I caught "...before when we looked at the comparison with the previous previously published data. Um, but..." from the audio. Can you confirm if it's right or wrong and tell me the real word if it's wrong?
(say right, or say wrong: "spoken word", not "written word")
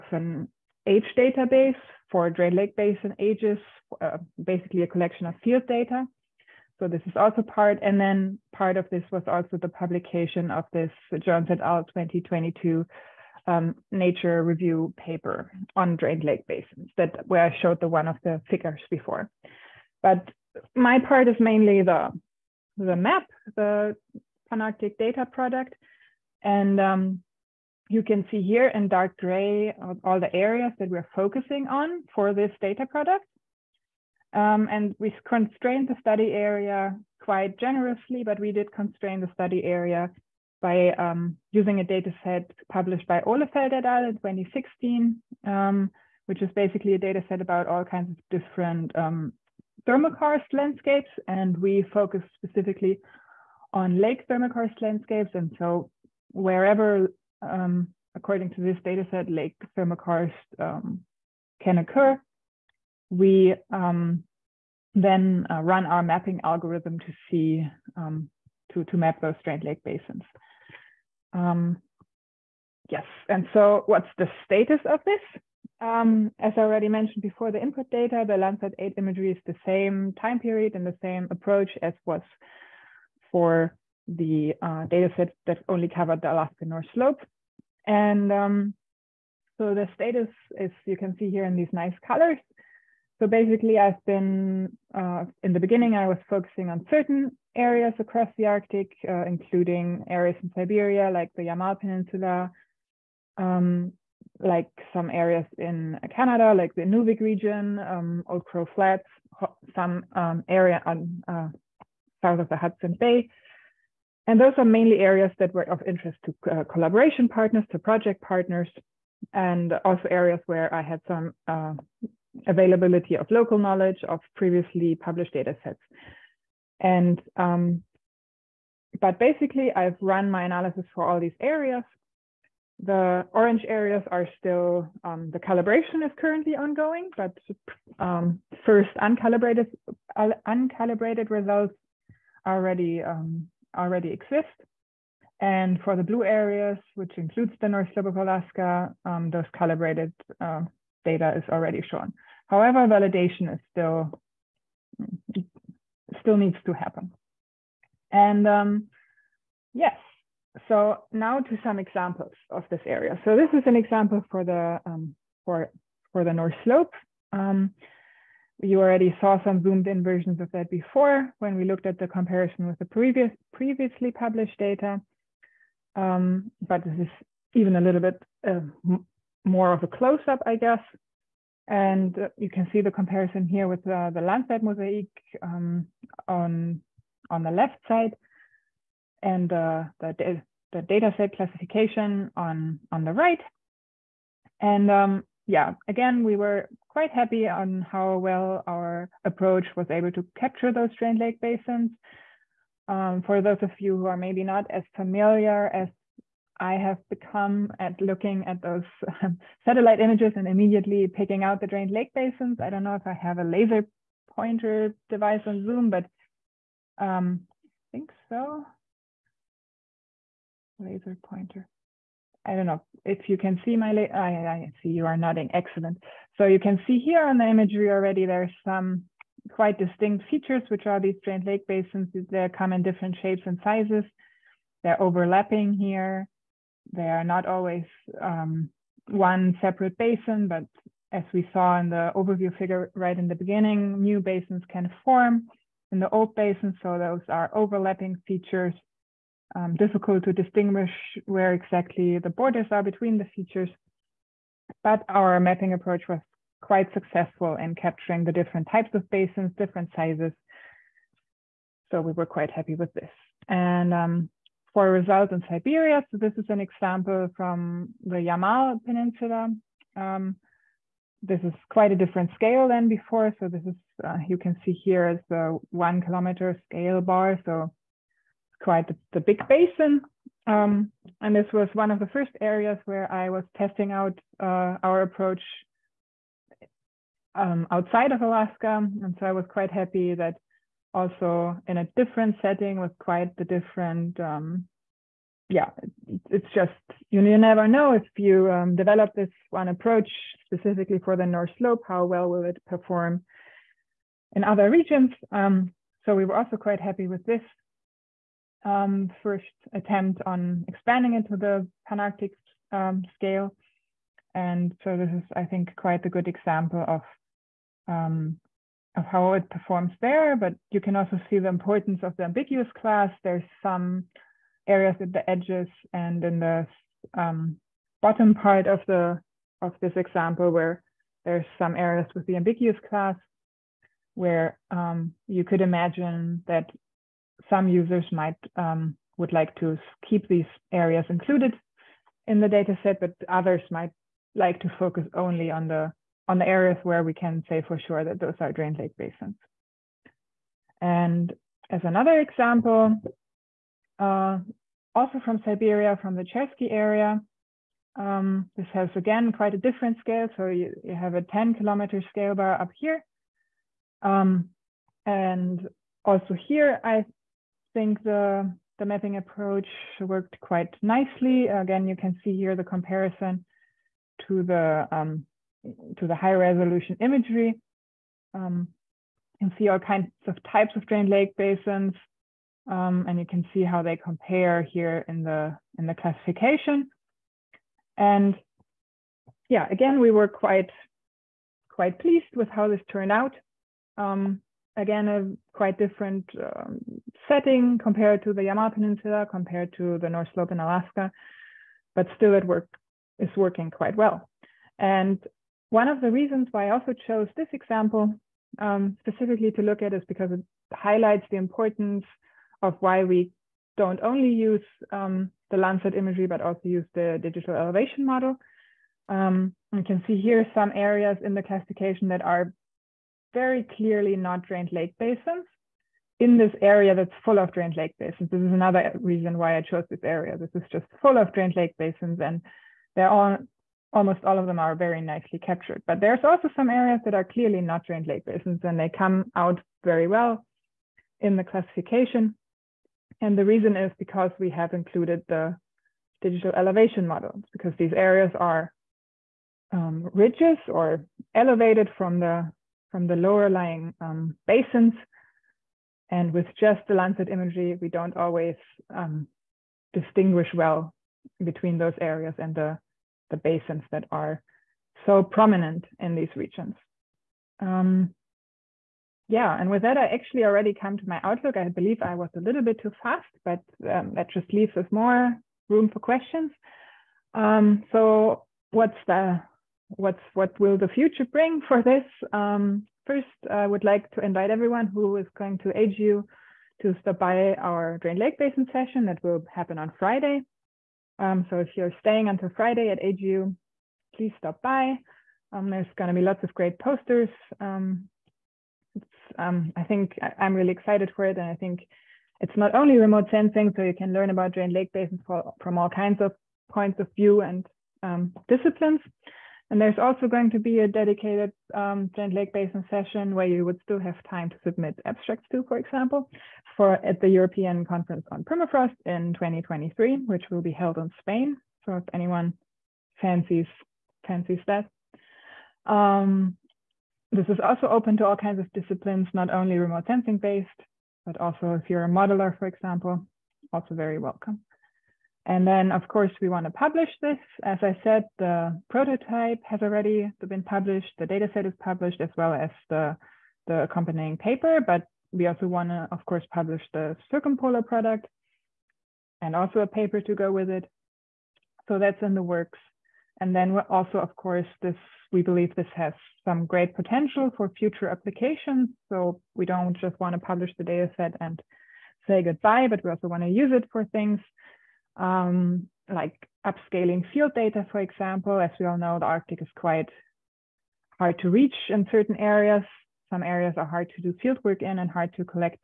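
right.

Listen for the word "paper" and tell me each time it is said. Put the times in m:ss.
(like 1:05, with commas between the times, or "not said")
0:14, 9:04, 9:09.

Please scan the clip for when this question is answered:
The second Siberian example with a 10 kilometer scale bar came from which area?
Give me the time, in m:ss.
5:56.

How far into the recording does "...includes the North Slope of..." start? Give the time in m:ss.
2:27.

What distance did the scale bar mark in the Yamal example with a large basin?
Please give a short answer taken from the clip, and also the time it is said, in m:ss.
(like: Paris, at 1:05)
1 kilometer, at 4:35.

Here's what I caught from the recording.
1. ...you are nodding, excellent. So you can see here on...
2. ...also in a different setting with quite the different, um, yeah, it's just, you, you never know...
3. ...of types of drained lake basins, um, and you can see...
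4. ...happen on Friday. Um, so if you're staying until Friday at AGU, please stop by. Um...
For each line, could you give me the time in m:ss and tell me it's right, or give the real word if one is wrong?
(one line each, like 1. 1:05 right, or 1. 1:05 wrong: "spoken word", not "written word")
1. 3:44 right
2. 4:50 right
3. 6:20 right
4. 8:09 right.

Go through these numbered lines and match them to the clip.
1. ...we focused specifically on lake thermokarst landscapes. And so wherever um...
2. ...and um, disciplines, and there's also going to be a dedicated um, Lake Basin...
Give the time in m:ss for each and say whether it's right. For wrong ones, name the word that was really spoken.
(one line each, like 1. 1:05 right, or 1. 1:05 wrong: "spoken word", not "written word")
1. 0:51 right
2. 8:27 right.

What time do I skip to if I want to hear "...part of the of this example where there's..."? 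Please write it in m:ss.
5:28.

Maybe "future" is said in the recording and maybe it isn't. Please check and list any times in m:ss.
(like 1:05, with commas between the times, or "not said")
8:00, 9:17.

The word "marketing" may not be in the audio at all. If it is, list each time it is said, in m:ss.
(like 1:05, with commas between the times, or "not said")
not said.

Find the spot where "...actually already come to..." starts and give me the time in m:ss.
7:50.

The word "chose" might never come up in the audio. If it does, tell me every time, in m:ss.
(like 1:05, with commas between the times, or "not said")
6:47, 7:09.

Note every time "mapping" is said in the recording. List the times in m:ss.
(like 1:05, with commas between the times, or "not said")
1:06, 4:15, 6:08.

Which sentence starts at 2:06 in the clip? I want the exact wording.
And, um, but basically I've run my analysis for all these areas.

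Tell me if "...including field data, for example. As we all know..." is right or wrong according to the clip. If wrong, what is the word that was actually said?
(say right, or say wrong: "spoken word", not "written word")
wrong: "upscaling", not "including".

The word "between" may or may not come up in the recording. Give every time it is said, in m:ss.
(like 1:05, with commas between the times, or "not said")
4:12, 7:41.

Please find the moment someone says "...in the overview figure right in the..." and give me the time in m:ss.
4:01.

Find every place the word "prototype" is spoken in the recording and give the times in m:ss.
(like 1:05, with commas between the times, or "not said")
8:58.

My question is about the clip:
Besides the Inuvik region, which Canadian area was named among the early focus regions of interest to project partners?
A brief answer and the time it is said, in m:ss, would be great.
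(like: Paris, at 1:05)
Old Crow Flats, at 1:48.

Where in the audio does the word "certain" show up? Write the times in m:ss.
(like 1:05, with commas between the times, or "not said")
1:36, 9:32.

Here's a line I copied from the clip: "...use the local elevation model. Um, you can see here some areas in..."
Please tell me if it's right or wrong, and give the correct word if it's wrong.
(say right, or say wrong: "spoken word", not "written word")
wrong: "digital", not "local".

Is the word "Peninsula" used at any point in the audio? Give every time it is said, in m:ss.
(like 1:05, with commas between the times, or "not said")
1:41, 4:28, 6:38.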